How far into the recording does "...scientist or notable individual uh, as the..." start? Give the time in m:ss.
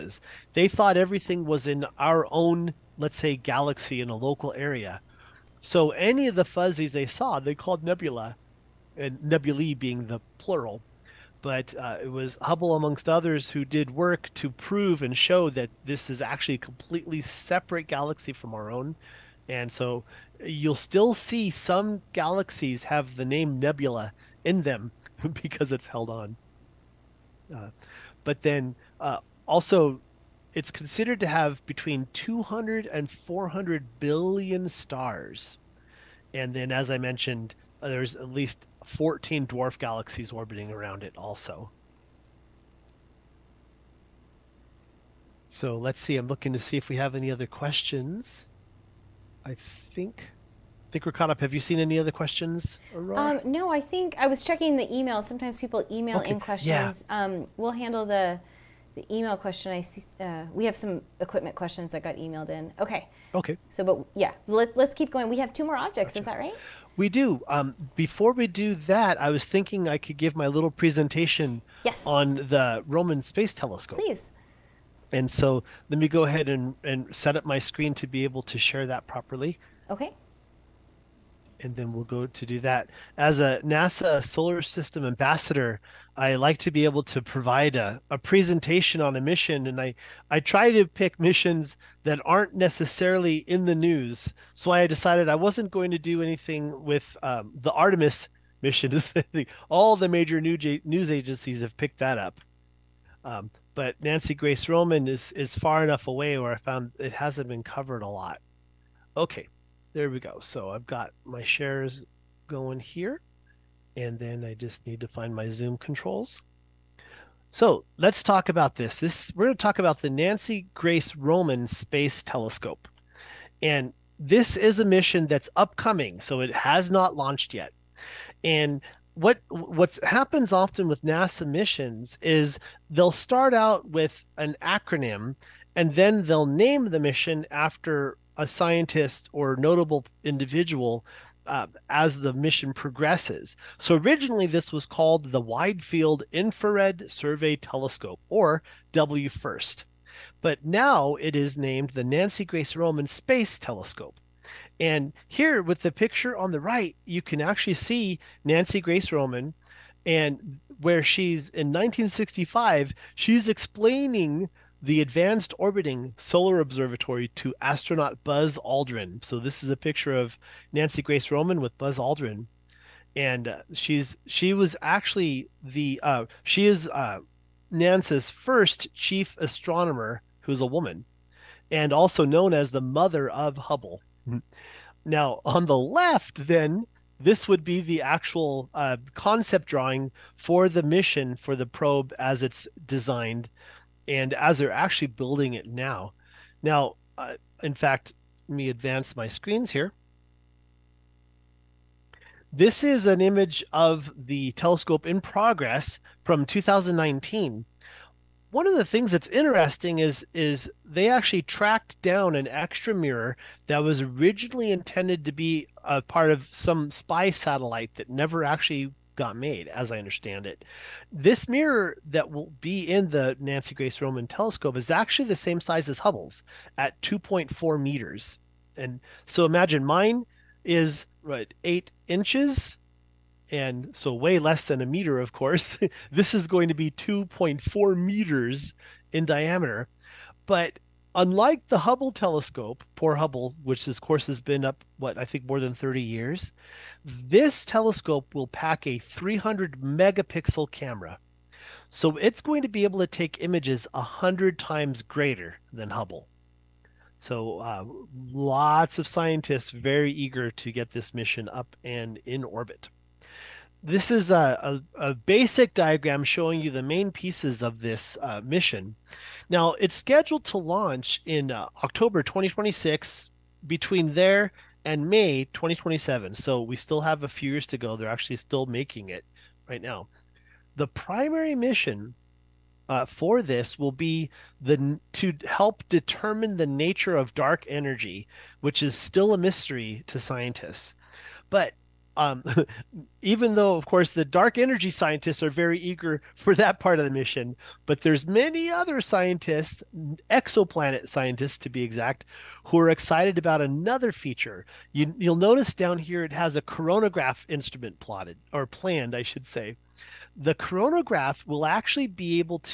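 2:18.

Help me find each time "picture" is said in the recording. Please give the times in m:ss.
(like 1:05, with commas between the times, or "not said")
2:35, 2:49.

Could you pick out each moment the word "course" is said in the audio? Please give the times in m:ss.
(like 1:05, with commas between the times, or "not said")
3:55, 4:03, 4:53.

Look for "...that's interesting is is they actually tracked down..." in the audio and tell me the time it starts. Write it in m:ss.
3:29.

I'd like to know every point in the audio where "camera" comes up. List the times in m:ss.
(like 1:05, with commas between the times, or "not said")
4:10.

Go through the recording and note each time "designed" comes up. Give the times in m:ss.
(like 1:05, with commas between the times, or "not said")
3:12.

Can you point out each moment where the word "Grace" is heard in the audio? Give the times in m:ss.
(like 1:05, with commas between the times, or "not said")
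1:44, 2:00, 2:32, 2:38, 2:51, 3:43.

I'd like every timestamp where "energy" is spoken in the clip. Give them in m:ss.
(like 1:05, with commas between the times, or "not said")
4:47, 4:54.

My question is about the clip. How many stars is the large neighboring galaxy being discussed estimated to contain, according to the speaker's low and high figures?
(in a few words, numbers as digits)
200 to 400 billion.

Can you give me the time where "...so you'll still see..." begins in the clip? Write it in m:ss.
0:19.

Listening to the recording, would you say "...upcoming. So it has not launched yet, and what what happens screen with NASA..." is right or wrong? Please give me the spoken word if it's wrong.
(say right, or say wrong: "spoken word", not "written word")
wrong: "often", not "screen".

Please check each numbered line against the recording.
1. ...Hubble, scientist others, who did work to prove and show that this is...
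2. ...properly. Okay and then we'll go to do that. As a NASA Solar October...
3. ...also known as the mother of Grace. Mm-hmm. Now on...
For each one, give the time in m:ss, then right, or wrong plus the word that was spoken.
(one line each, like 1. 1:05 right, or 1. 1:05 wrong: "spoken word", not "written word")
1. 0:12 wrong: "amongst", not "scientist"
2. 1:19 wrong: "System", not "October"
3. 3:01 wrong: "Hubble", not "Grace".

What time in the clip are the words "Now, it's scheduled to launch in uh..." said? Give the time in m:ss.
4:29.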